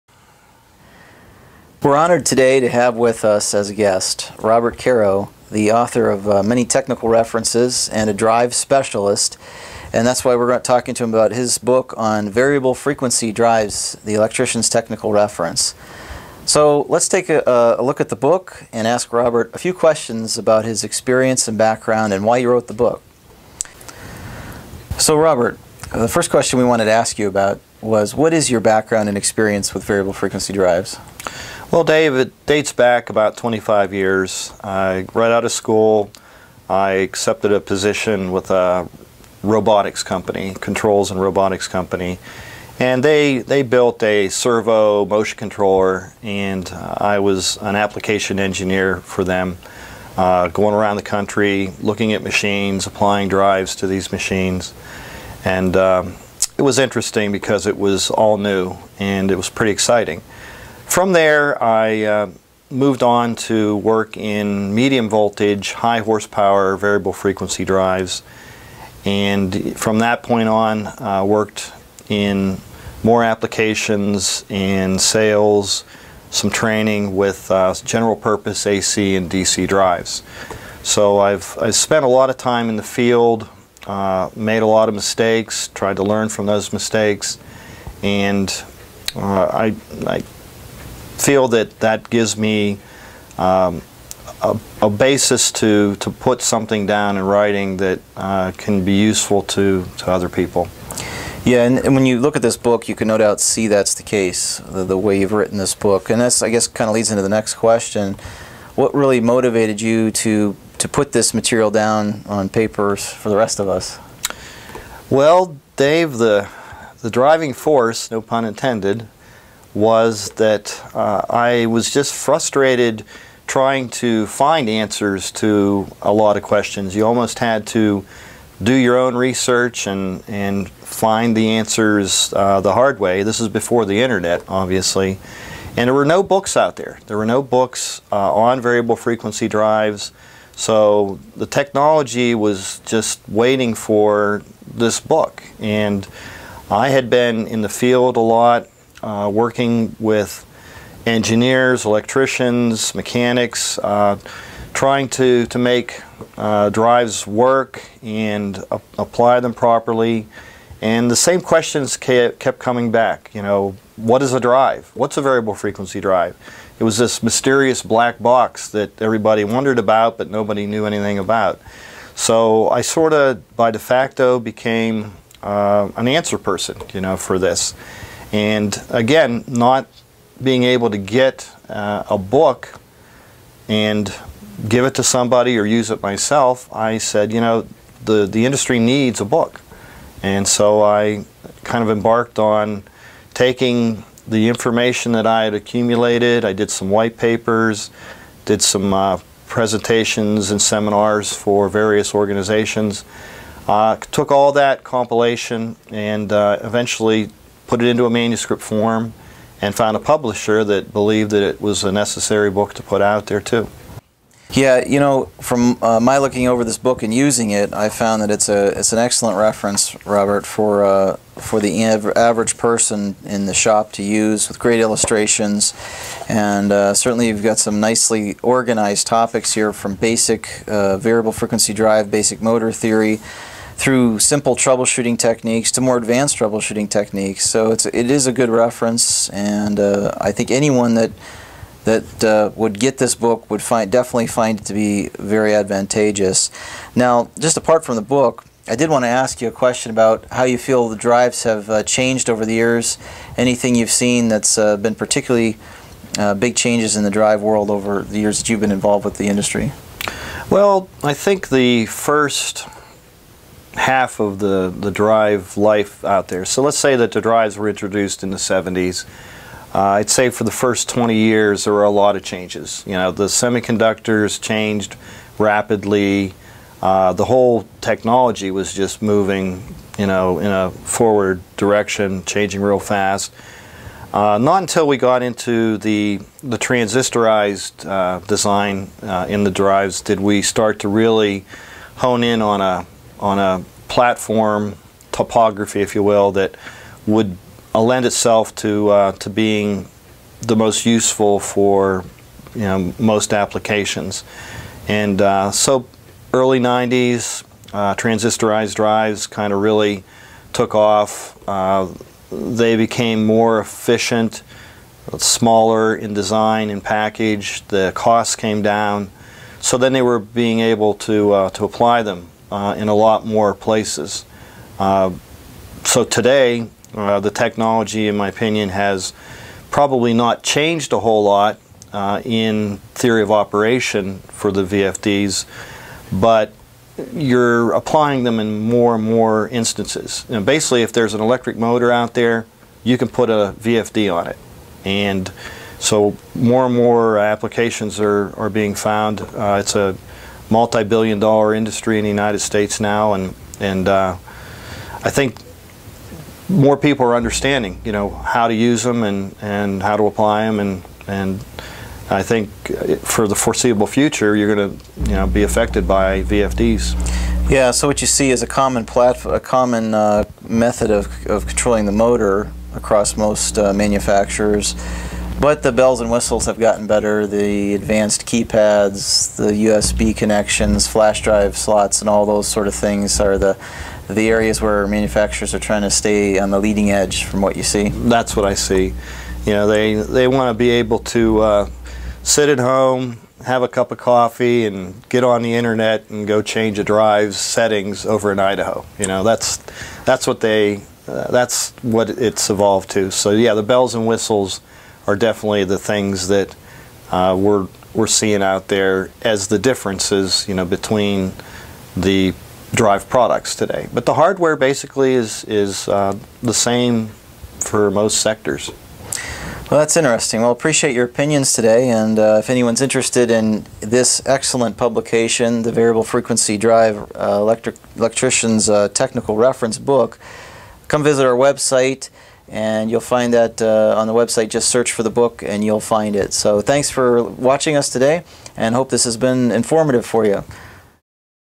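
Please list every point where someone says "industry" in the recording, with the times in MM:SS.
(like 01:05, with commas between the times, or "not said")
03:08, 04:19, 05:51.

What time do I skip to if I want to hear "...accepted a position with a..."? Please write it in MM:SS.
00:36.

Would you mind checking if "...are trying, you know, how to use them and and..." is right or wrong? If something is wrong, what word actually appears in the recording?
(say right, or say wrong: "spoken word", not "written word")
wrong: "understanding", not "trying".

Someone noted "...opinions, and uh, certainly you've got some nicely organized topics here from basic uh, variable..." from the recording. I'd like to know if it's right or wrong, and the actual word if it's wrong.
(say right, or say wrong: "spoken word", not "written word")
wrong: "illustrations", not "opinions".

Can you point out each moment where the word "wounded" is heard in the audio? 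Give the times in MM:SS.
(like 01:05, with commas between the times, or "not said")
not said.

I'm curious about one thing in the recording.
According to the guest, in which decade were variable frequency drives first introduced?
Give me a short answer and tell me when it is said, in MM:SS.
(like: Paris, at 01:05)
the 70s, at 04:28.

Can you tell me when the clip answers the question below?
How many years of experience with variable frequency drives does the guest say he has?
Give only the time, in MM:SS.
00:33.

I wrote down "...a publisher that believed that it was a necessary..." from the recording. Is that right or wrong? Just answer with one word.
right.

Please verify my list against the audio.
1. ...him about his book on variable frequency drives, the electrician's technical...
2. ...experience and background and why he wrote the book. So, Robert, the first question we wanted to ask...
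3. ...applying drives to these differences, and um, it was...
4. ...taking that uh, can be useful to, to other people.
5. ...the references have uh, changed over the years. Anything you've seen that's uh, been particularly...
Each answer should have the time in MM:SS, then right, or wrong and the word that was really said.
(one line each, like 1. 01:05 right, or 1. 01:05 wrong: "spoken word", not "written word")
1. 00:11 right
2. 00:20 right
3. 00:52 wrong: "machines", not "differences"
4. 01:37 wrong: "writing", not "taking"
5. 04:10 wrong: "drives", not "references".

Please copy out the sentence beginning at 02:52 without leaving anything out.
So I sort of, by de facto, became uh, an answer person, you know, for this.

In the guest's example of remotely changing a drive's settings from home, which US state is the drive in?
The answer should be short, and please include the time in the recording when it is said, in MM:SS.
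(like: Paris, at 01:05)
Idaho, at 06:38.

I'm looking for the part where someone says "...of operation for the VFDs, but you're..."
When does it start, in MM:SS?
05:33.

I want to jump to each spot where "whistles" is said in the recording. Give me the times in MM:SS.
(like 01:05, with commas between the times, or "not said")
06:16, 06:44.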